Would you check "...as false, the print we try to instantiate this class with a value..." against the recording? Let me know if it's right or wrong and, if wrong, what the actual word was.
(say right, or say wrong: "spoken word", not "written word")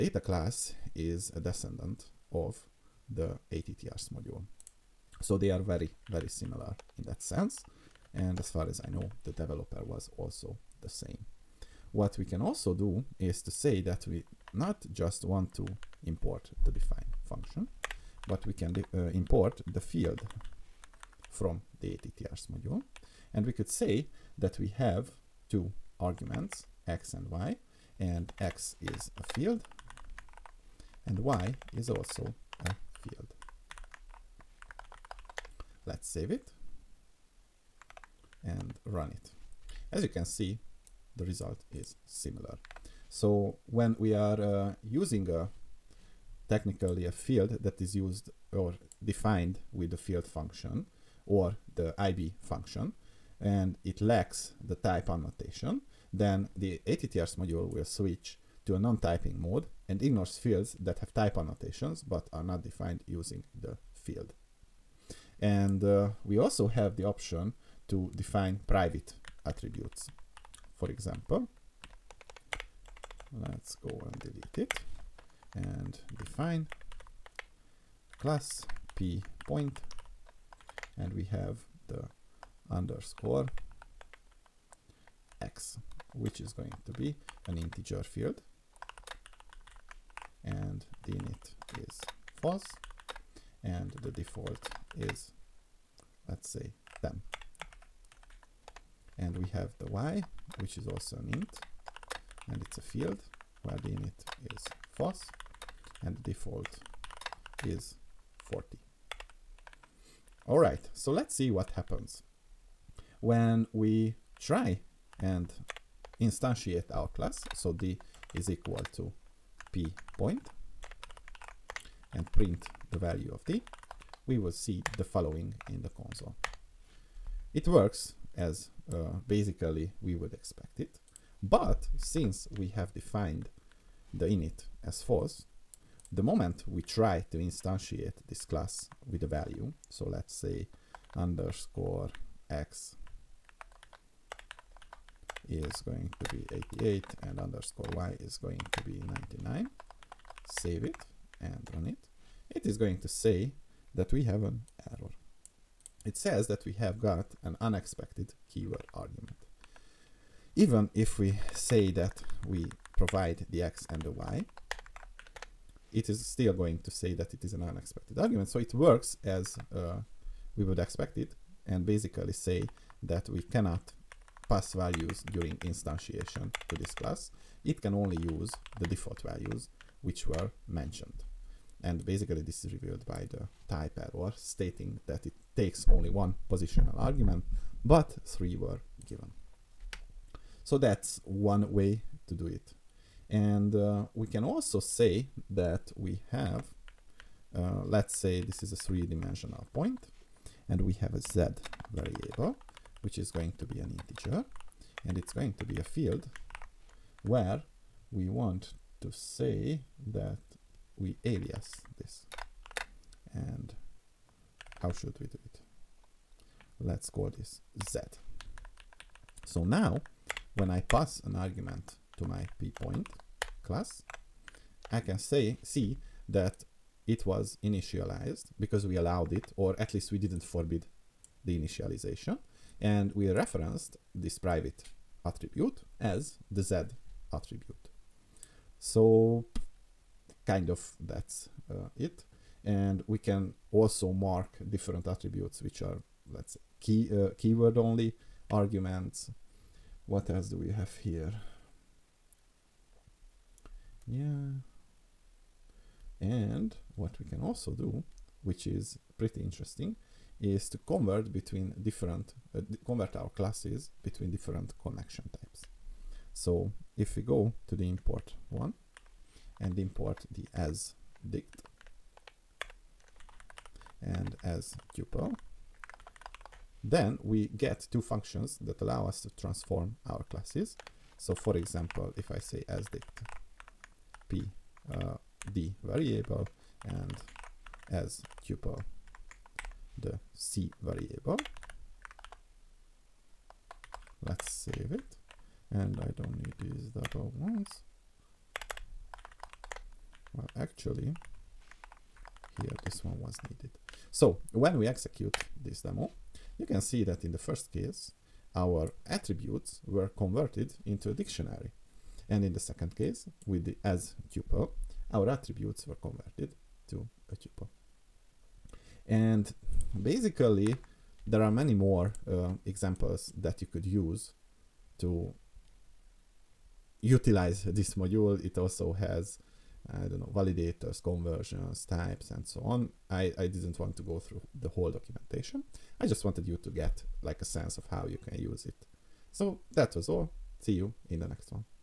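wrong: "moment", not "print".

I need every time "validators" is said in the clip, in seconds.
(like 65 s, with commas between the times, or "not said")
330 s.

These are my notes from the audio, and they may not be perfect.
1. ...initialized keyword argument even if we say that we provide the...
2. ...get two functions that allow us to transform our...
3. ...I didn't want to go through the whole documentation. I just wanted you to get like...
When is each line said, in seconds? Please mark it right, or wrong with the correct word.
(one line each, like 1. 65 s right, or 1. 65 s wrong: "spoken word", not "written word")
1. 157 s wrong: "unexpected", not "initialized"
2. 277 s right
3. 333 s right.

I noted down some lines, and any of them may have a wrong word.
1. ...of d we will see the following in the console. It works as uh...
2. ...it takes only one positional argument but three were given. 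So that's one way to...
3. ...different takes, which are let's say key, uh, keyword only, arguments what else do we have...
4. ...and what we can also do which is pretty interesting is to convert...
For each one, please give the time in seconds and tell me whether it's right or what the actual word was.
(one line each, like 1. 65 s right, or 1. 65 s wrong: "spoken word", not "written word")
1. 123 s right
2. 185 s right
3. 244 s wrong: "attributes", not "takes"
4. 256 s right.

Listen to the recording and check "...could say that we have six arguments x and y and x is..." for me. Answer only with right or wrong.
wrong.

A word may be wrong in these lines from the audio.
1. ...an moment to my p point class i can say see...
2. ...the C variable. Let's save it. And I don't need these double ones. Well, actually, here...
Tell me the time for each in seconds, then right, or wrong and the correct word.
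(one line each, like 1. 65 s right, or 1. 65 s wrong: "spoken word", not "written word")
1. 221 s wrong: "argument", not "moment"
2. 289 s right.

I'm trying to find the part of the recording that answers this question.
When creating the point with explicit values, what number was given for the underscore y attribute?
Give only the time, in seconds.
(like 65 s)
149 s.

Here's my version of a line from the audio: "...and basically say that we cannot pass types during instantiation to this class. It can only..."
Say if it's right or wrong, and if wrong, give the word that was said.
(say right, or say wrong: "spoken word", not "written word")
wrong: "values", not "types".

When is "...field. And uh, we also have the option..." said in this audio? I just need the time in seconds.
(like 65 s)
63 s.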